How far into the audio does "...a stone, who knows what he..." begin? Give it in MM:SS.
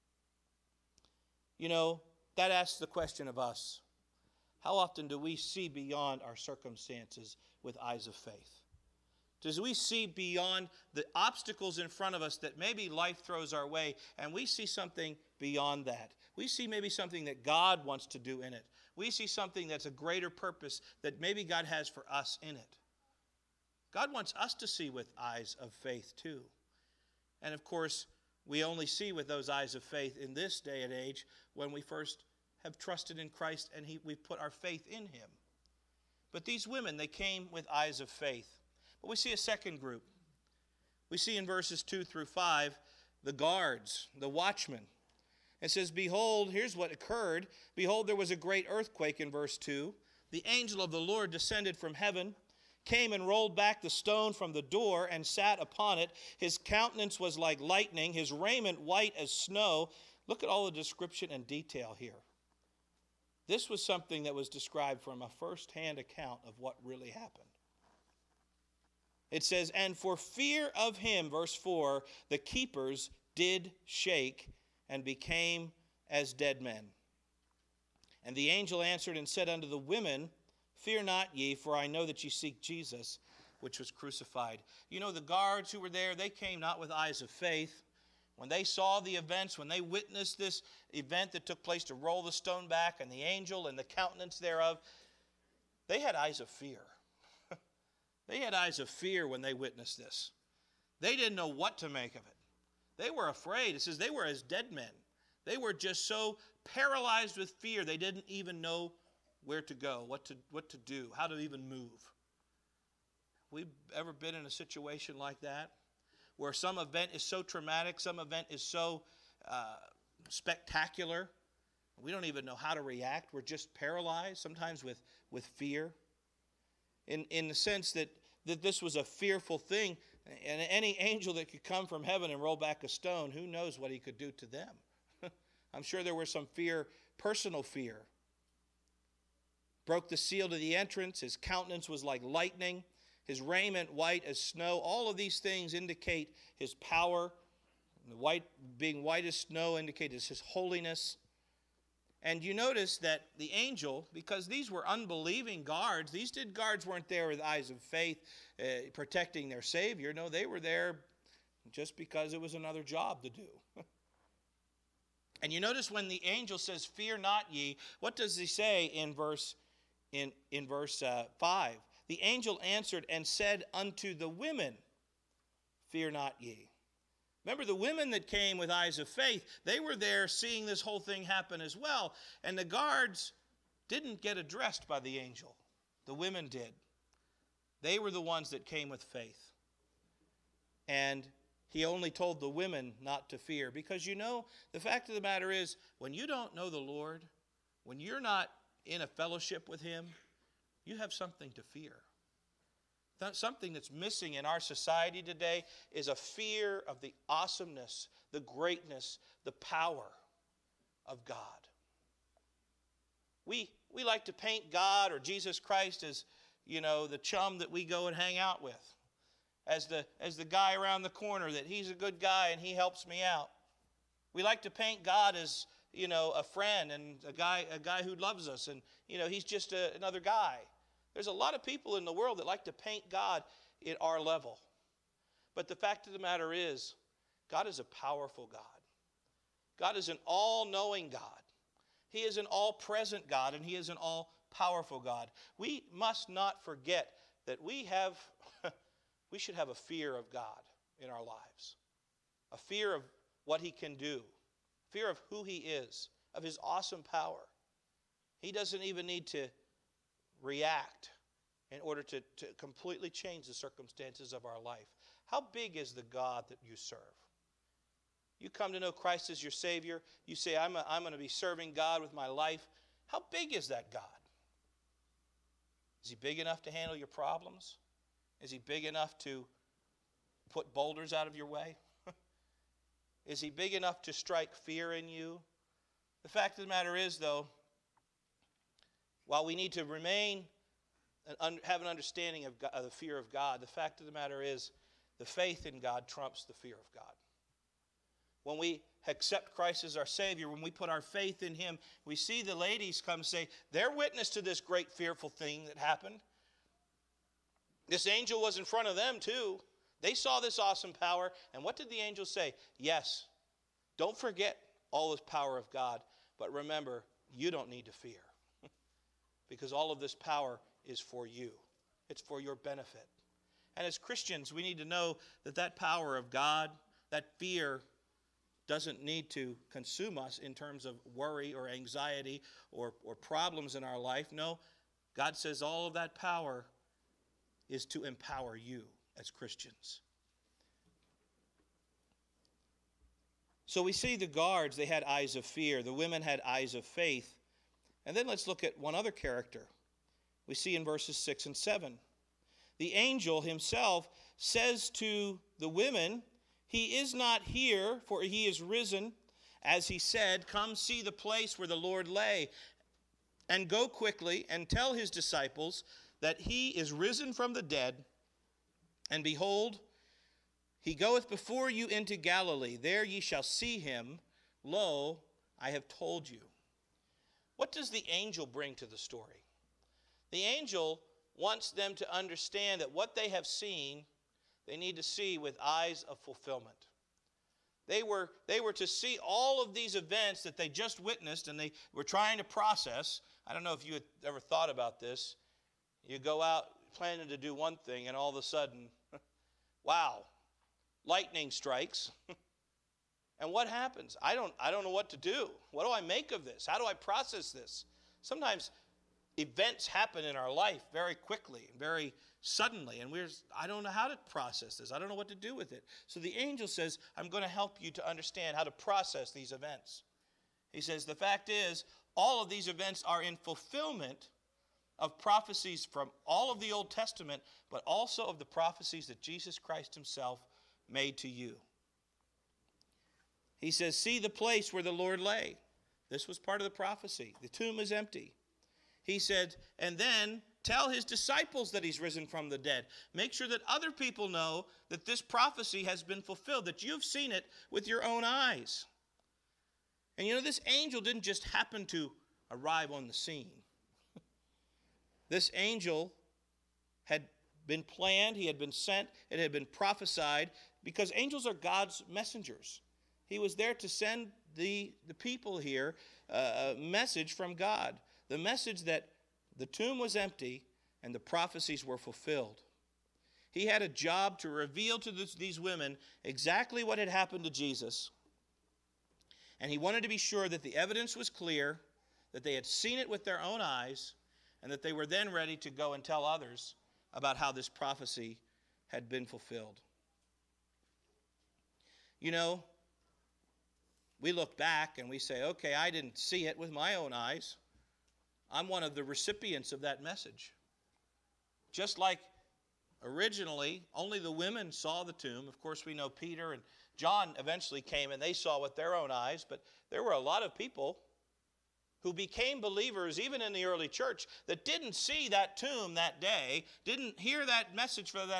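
02:12.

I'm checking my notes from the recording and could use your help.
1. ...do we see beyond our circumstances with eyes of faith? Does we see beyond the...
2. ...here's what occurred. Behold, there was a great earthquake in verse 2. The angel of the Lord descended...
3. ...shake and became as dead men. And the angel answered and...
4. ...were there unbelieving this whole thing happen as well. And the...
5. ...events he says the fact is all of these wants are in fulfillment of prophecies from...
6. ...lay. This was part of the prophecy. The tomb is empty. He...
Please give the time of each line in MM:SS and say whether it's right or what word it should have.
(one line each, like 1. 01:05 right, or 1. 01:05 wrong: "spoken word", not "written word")
1. 00:05 right
2. 00:46 right
3. 01:13 right
4. 02:59 wrong: "seeing", not "unbelieving"
5. 06:59 wrong: "events", not "wants"
6. 07:15 right.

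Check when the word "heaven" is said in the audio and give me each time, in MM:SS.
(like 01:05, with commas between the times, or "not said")
00:51, 02:12.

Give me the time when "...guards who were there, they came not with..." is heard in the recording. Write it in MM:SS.
01:25.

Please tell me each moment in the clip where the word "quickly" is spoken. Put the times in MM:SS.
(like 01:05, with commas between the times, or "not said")
06:03, 06:51.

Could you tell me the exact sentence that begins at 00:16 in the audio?
We see maybe something that God wants to do in it.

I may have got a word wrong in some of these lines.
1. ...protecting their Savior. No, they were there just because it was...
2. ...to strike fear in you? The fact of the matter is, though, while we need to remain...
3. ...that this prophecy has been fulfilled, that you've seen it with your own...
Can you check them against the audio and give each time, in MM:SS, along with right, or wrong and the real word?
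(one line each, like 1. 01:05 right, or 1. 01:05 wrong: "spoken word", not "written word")
1. 02:38 right
2. 04:44 right
3. 07:24 right.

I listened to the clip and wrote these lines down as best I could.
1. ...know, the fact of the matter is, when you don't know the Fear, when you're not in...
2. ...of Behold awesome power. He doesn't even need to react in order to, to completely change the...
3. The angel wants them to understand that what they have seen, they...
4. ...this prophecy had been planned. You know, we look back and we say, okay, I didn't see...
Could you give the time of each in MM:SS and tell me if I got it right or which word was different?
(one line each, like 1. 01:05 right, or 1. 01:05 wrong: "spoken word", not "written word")
1. 03:14 wrong: "Lord", not "Fear"
2. 04:16 wrong: "His", not "Behold"
3. 06:20 right
4. 08:07 wrong: "fulfilled", not "planned".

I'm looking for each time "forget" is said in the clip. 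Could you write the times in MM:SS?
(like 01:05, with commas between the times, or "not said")
04:06, 05:14.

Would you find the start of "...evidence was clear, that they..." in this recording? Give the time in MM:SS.
08:00.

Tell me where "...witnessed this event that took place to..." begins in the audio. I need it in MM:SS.
01:29.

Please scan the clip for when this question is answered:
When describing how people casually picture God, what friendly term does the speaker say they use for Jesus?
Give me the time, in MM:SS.
03:37.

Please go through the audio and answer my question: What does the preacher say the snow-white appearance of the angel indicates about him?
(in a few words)
his holiness.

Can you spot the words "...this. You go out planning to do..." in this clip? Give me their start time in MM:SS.
06:34.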